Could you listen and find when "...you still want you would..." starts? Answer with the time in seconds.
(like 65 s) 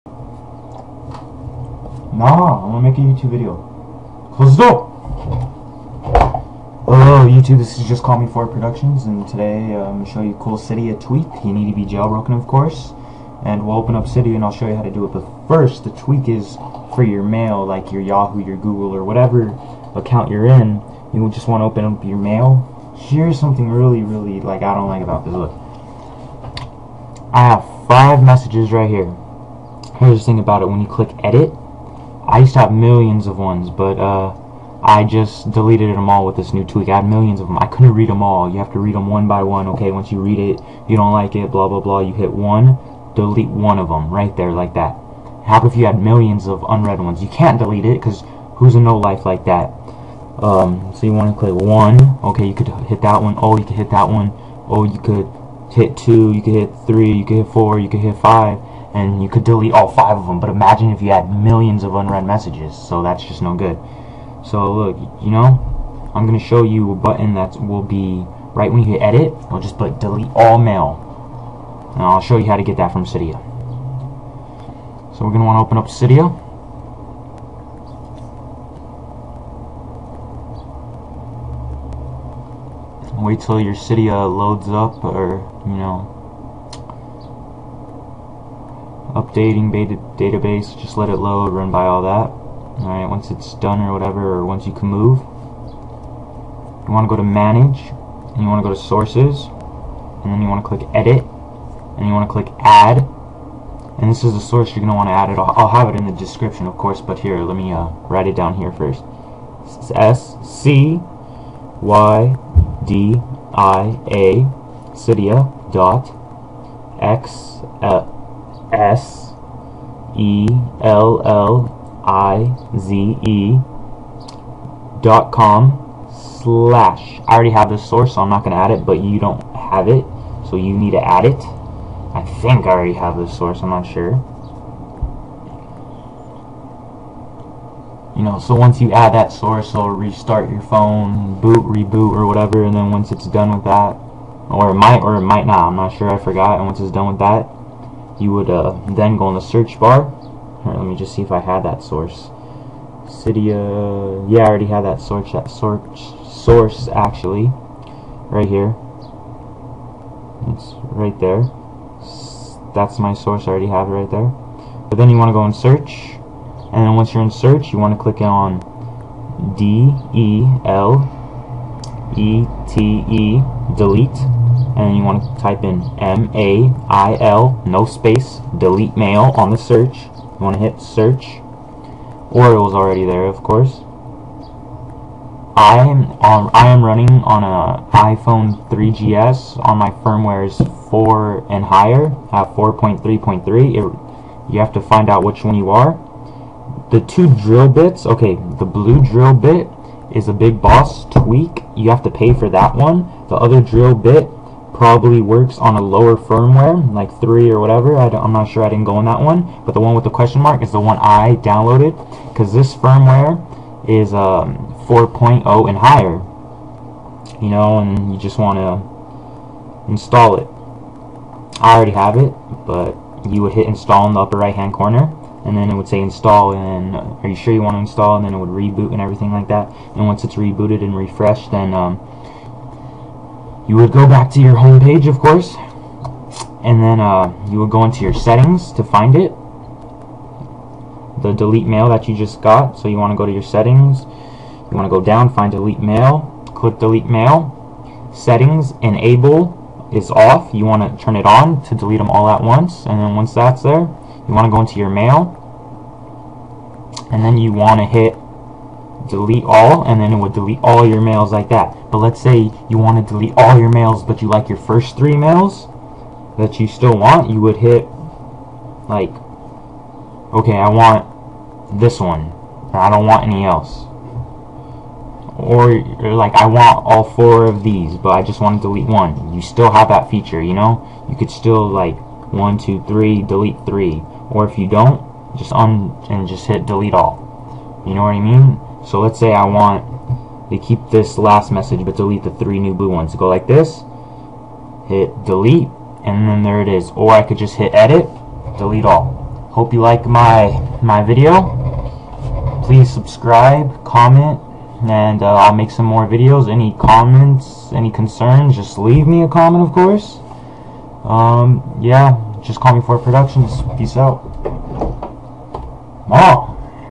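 266 s.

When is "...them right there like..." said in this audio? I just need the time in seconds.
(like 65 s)
43 s.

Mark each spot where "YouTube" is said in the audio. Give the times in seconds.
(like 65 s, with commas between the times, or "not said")
3 s, 7 s.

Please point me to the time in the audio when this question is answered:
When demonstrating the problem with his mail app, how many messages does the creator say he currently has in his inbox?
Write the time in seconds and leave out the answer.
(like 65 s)
27 s.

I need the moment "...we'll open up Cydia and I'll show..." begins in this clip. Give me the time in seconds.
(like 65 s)
13 s.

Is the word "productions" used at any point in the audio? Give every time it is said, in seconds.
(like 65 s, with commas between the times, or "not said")
8 s, 312 s.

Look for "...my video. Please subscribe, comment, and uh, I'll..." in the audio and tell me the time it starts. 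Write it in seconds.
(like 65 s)
300 s.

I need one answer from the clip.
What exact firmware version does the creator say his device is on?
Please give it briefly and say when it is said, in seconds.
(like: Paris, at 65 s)
4.3.3, at 192 s.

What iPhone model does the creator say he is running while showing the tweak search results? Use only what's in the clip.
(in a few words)
iPhone 3GS.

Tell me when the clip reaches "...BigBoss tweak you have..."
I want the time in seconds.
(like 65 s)
200 s.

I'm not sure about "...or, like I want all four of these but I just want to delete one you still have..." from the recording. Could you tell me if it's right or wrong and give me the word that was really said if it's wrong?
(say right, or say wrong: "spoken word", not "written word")
right.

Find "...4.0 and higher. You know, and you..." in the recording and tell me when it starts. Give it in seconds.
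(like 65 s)
214 s.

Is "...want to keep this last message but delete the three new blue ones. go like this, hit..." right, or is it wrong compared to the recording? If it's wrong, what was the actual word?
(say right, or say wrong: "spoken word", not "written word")
right.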